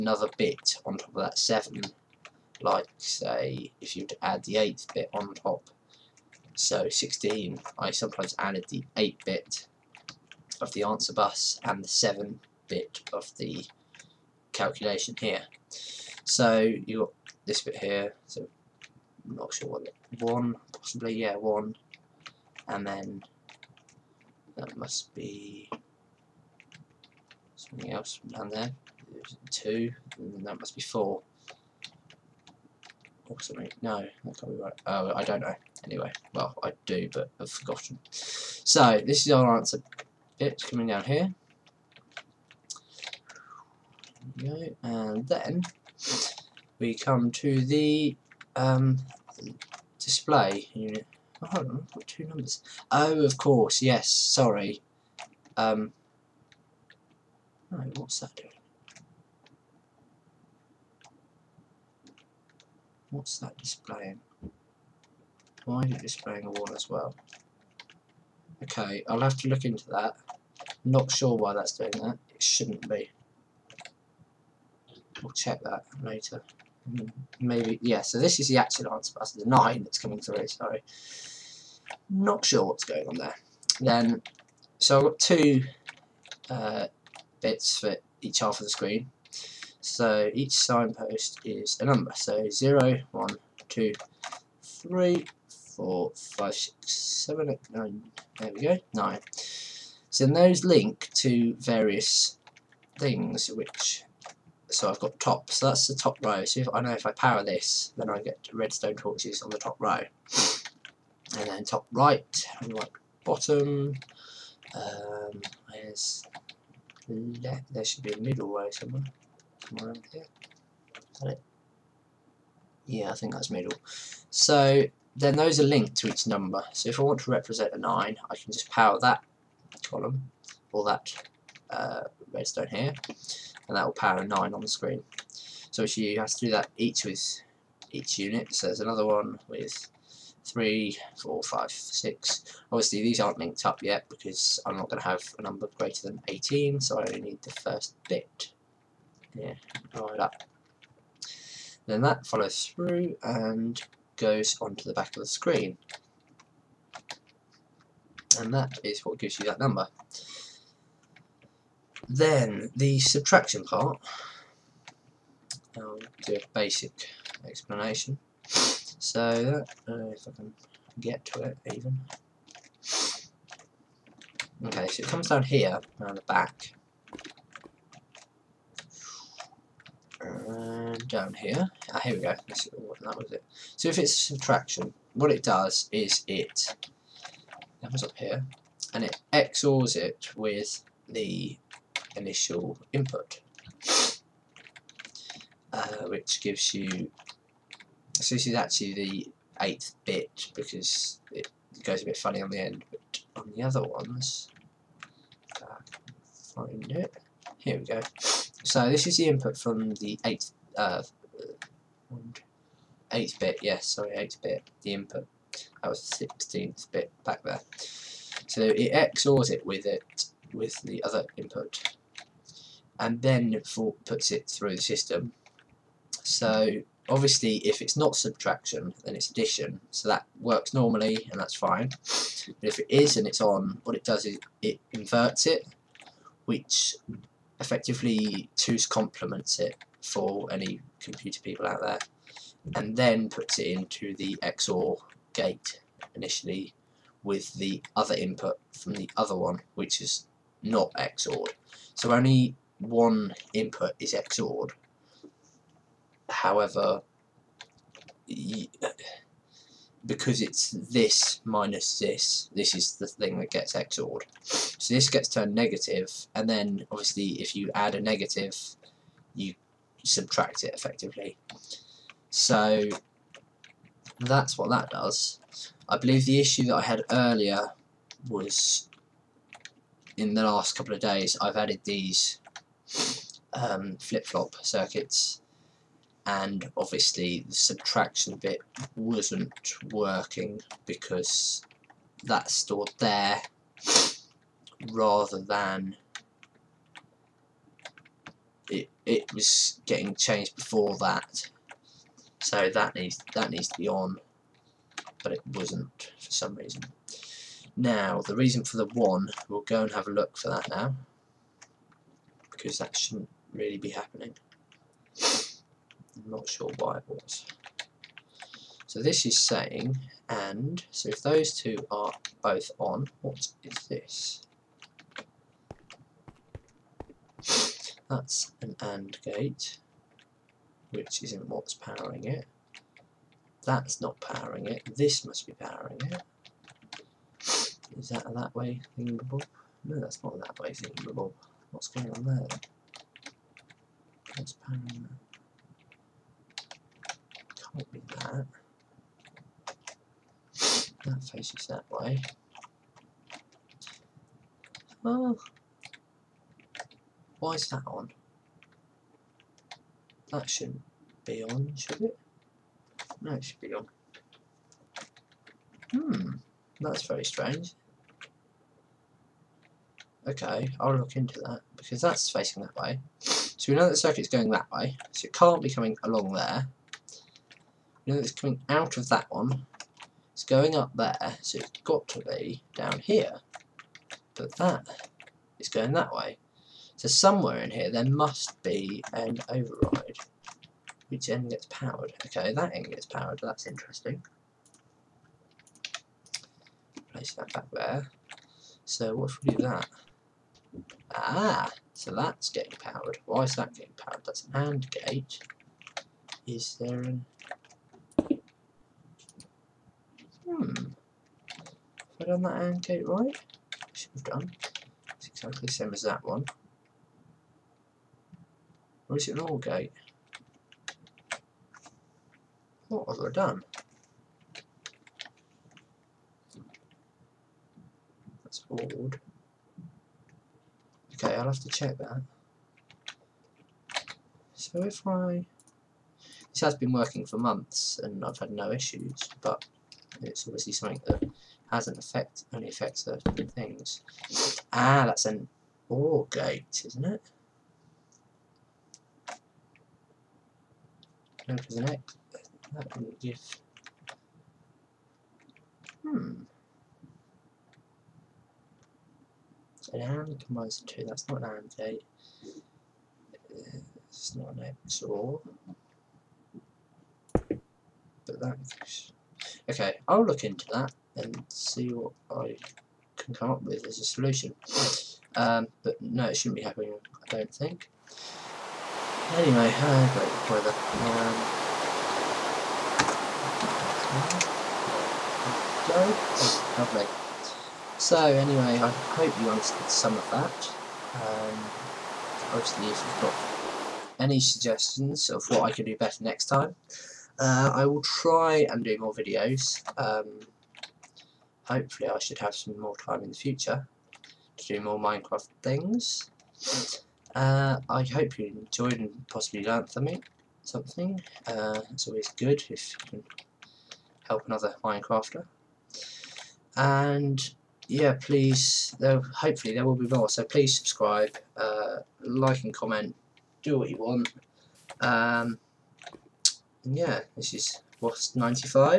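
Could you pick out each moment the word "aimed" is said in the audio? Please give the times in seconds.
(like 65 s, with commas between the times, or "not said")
not said.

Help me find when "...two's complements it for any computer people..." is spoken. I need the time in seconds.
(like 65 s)
238 s.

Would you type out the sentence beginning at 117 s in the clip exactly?
There should be a middle row somewhere.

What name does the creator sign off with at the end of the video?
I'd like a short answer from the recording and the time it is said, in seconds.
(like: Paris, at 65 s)
Wosp 95, at 528 s.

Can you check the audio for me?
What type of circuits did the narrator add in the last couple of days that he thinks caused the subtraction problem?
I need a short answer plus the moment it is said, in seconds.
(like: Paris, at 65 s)
flip-flop circuits, at 283 s.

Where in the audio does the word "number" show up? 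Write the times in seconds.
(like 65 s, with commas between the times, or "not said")
52 s, 91 s, 126 s, 145 s, 159 s.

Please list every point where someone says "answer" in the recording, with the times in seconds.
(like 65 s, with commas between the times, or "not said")
10 s, 39 s, 78 s.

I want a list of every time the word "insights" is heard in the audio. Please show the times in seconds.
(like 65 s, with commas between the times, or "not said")
not said.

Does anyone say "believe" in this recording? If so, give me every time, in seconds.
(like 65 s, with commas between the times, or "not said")
275 s.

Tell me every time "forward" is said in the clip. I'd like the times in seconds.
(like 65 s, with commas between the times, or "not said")
428 s.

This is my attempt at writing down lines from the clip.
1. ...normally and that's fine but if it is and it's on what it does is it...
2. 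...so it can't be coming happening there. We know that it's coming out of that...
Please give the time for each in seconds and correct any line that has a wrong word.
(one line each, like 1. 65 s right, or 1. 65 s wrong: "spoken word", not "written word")
1. 230 s right
2. 375 s wrong: "along", not "happening".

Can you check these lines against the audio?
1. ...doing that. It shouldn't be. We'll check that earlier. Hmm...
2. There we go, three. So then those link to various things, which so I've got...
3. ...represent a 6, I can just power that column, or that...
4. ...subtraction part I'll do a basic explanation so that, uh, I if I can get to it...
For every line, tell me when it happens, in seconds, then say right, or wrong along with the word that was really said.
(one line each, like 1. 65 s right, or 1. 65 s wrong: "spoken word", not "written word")
1. 71 s wrong: "later", not "earlier"
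2. 98 s wrong: "nine", not "three"
3. 127 s wrong: "9", not "6"
4. 162 s right.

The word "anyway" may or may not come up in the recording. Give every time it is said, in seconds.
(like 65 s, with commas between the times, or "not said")
35 s, 479 s, 488 s.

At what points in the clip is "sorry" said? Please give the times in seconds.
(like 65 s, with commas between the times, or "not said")
54 s, 80 s, 213 s.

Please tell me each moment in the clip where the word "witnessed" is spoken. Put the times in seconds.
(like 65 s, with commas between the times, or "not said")
not said.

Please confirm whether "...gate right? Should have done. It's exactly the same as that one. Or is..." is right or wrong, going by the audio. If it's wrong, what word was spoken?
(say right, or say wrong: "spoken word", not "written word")
right.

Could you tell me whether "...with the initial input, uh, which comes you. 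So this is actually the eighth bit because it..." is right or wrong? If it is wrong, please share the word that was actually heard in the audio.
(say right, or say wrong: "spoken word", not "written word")
wrong: "gives", not "comes".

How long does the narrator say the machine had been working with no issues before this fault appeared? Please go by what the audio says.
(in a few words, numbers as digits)
months.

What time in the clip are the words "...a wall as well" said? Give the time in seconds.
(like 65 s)
66 s.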